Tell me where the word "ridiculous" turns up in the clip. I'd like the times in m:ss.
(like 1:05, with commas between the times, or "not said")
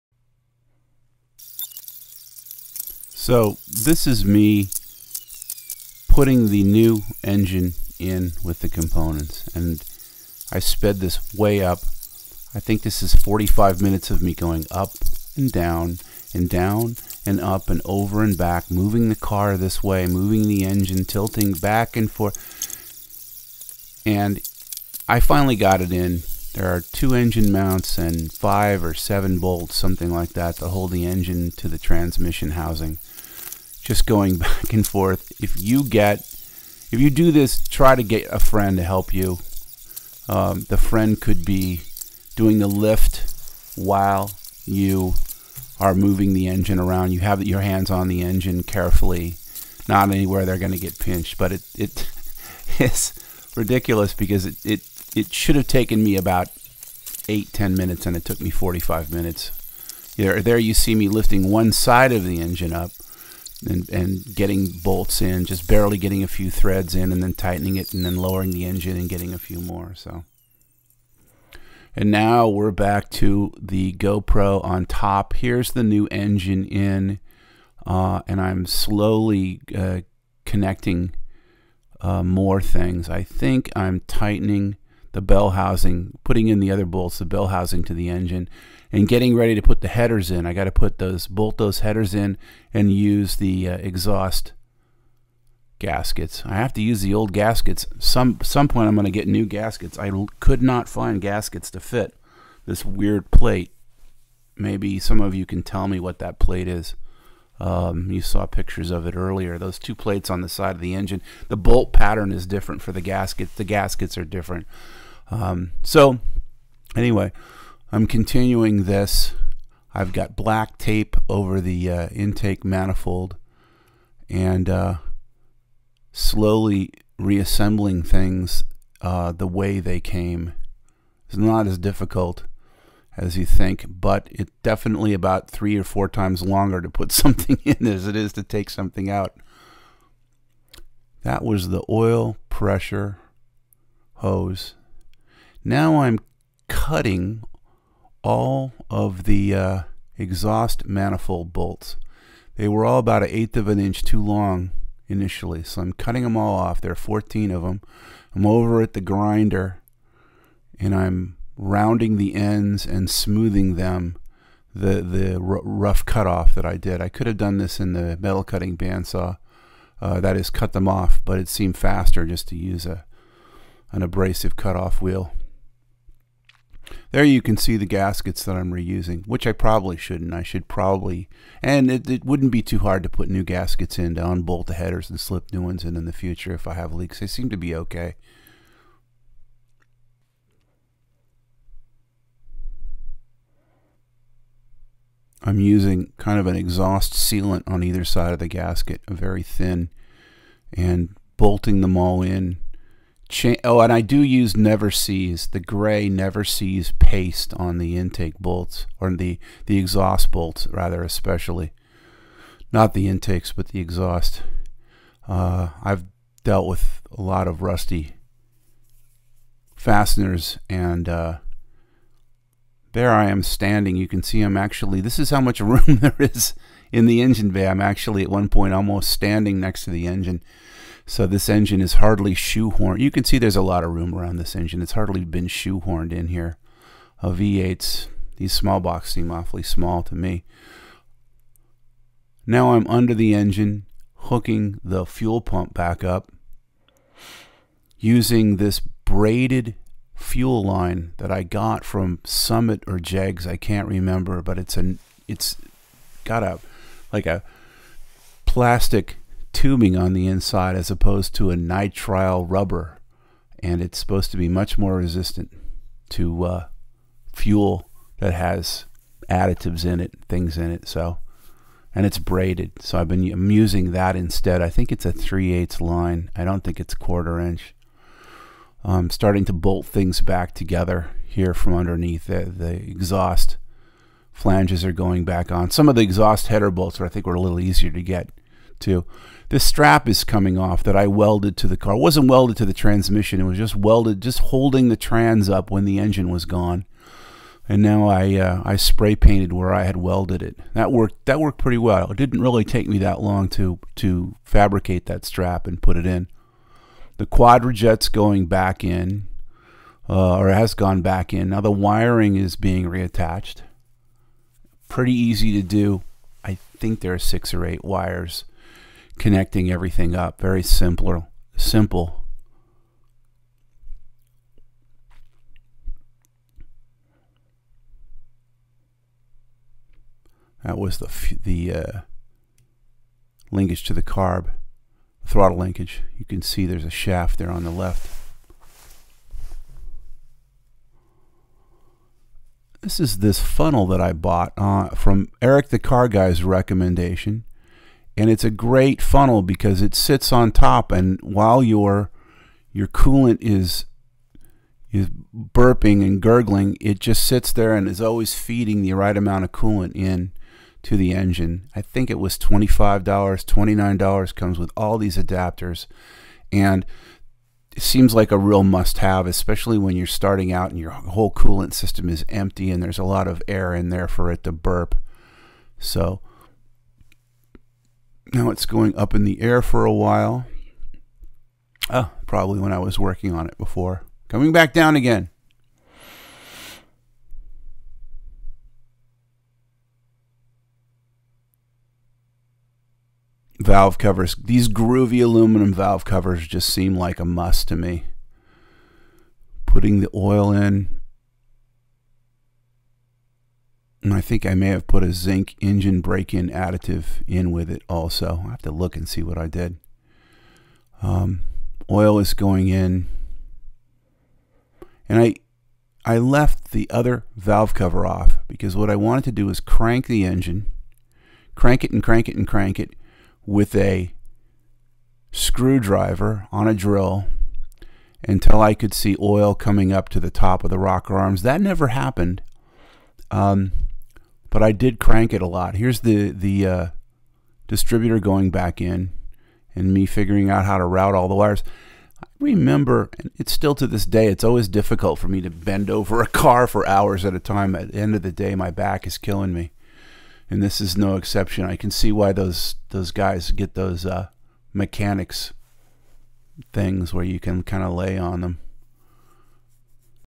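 0:53.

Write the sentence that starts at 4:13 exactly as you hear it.
I can't remember, but it's an it's got a like a plastic tubing on the inside as opposed to a nitrile rubber.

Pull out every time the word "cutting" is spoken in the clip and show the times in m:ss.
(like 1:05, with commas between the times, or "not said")
2:26, 2:35, 2:48.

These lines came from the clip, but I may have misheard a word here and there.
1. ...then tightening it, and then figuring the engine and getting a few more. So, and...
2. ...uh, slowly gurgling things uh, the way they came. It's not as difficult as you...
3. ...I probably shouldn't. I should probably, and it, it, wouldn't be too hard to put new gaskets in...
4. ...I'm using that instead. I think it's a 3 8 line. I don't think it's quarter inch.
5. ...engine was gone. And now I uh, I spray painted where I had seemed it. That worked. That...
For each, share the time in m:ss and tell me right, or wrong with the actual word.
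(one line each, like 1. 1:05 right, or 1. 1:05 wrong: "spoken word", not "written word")
1. 1:07 wrong: "lowering", not "figuring"
2. 2:04 wrong: "reassembling", not "gurgling"
3. 2:59 right
4. 4:33 right
5. 4:55 wrong: "welded", not "seemed".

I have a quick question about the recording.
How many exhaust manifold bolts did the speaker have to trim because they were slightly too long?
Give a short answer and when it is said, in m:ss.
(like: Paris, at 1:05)
14, at 2:36.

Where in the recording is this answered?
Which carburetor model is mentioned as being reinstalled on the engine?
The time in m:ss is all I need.
5:07.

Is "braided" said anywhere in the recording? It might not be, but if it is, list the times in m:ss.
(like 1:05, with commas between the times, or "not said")
4:08, 4:32.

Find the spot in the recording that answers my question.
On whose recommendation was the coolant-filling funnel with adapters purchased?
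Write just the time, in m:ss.
5:45.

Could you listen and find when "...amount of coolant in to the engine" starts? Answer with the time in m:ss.
5:59.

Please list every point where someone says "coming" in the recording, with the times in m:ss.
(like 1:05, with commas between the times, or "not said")
4:50, 6:24, 7:09.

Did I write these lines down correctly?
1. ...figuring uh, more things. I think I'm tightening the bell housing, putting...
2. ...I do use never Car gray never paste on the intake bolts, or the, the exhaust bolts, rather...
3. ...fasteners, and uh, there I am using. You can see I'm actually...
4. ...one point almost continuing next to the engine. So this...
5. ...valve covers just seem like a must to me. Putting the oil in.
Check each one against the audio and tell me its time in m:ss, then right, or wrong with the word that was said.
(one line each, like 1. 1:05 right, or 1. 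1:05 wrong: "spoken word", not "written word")
1. 1:20 wrong: "connecting", not "figuring"
2. 3:23 wrong: "The", not "Car"
3. 3:39 wrong: "standing", not "using"
4. 3:48 wrong: "standing", not "continuing"
5. 6:35 right.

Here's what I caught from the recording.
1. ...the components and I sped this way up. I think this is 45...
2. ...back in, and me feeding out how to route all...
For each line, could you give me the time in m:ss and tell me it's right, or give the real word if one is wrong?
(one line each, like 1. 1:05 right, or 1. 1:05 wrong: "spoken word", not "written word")
1. 0:08 right
2. 7:18 wrong: "figuring", not "feeding".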